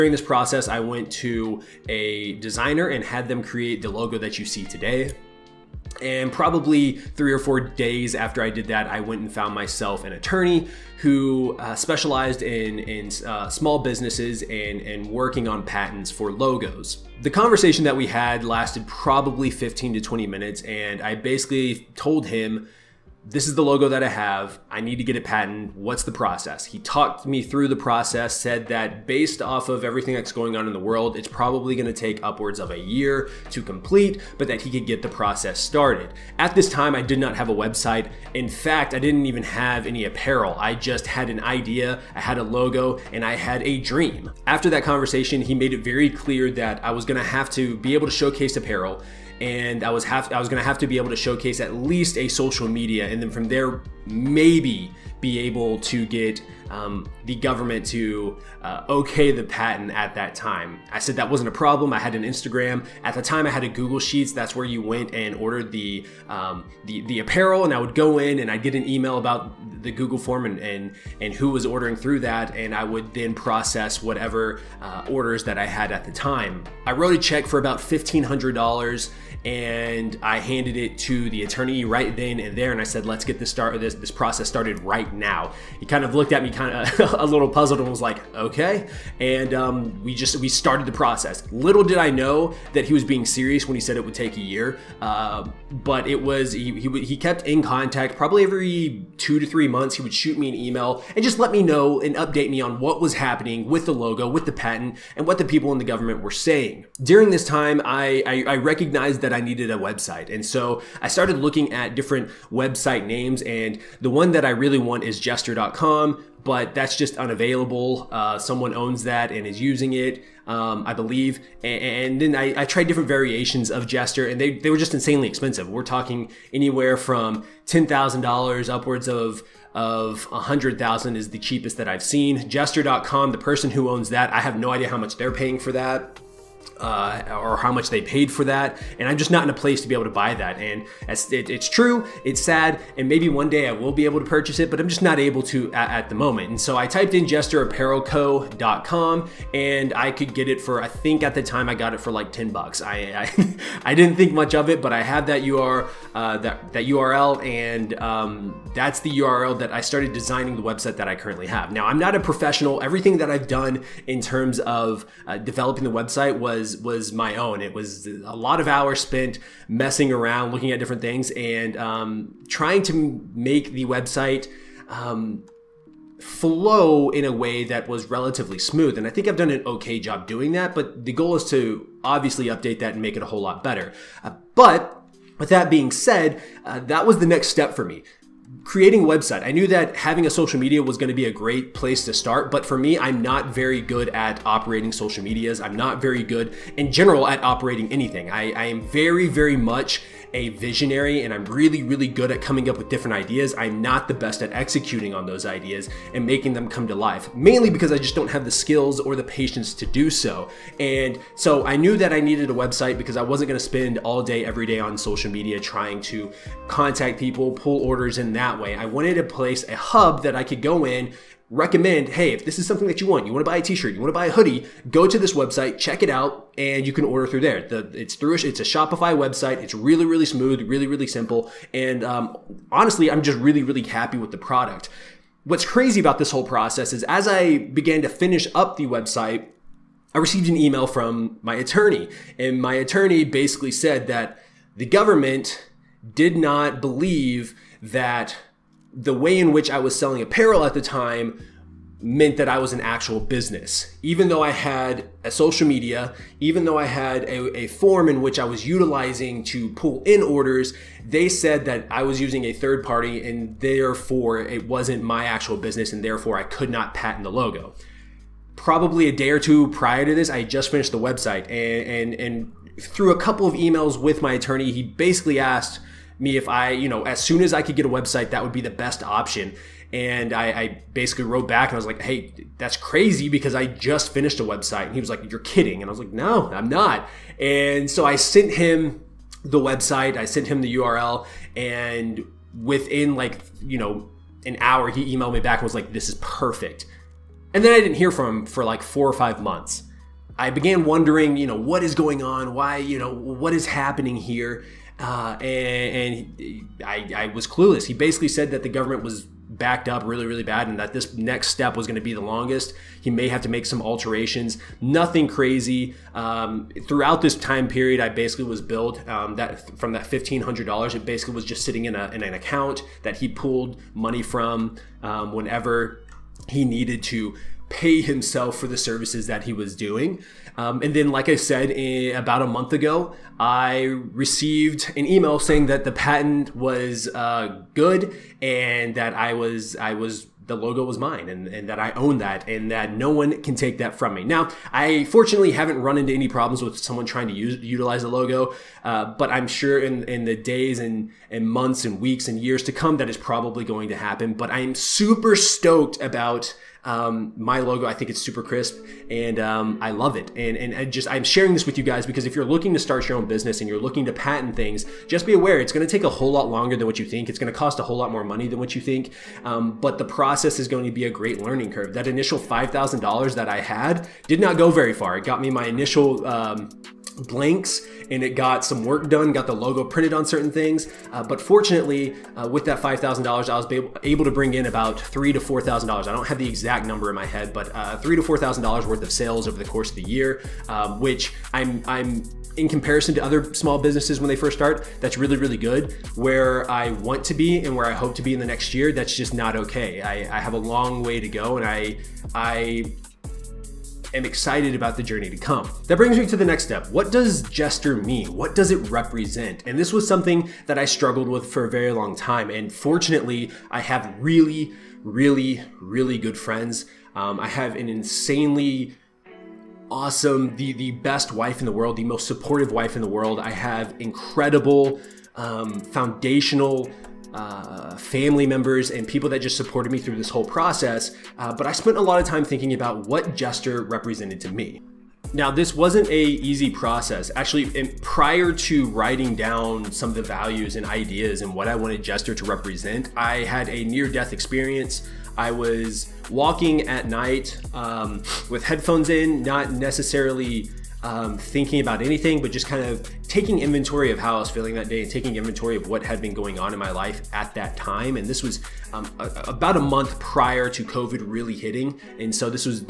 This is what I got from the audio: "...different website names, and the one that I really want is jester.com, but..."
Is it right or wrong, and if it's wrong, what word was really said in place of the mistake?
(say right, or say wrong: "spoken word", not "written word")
right.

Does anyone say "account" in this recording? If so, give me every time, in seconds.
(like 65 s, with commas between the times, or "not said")
322 s.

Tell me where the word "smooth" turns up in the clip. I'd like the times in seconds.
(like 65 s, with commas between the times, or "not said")
178 s, 230 s.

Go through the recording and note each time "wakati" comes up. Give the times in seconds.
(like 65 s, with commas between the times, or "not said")
not said.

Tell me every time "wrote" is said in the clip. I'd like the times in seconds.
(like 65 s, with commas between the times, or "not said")
76 s, 281 s.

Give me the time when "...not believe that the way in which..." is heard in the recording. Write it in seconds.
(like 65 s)
246 s.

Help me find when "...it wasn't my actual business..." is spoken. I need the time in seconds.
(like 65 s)
264 s.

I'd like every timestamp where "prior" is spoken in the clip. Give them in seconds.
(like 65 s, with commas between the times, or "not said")
269 s, 438 s, 460 s.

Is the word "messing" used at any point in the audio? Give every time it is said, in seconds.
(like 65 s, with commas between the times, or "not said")
169 s.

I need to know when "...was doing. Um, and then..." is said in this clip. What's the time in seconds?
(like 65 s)
329 s.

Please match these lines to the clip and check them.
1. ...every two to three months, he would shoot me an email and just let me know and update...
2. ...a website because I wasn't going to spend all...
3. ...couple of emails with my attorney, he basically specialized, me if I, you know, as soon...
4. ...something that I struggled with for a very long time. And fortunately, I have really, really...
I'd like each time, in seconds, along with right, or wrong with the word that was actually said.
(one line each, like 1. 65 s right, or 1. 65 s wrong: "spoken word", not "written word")
1. 98 s right
2. 212 s right
3. 273 s wrong: "asked", not "specialized"
4. 410 s right.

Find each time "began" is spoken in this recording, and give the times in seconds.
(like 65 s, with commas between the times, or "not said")
237 s, 300 s.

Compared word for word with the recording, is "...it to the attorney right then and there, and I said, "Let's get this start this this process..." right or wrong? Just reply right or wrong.
right.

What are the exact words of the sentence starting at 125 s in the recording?
We're talking anywhere from $10,000 upwards of of 100,000 is the cheapest that I've seen.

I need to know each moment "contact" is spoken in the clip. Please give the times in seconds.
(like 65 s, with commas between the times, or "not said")
97 s, 216 s.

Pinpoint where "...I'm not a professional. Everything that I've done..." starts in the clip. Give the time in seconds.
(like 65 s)
161 s.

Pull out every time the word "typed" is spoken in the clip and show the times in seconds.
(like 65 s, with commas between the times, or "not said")
146 s.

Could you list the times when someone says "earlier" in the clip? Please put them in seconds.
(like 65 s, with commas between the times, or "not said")
not said.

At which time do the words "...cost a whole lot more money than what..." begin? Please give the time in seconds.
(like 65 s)
367 s.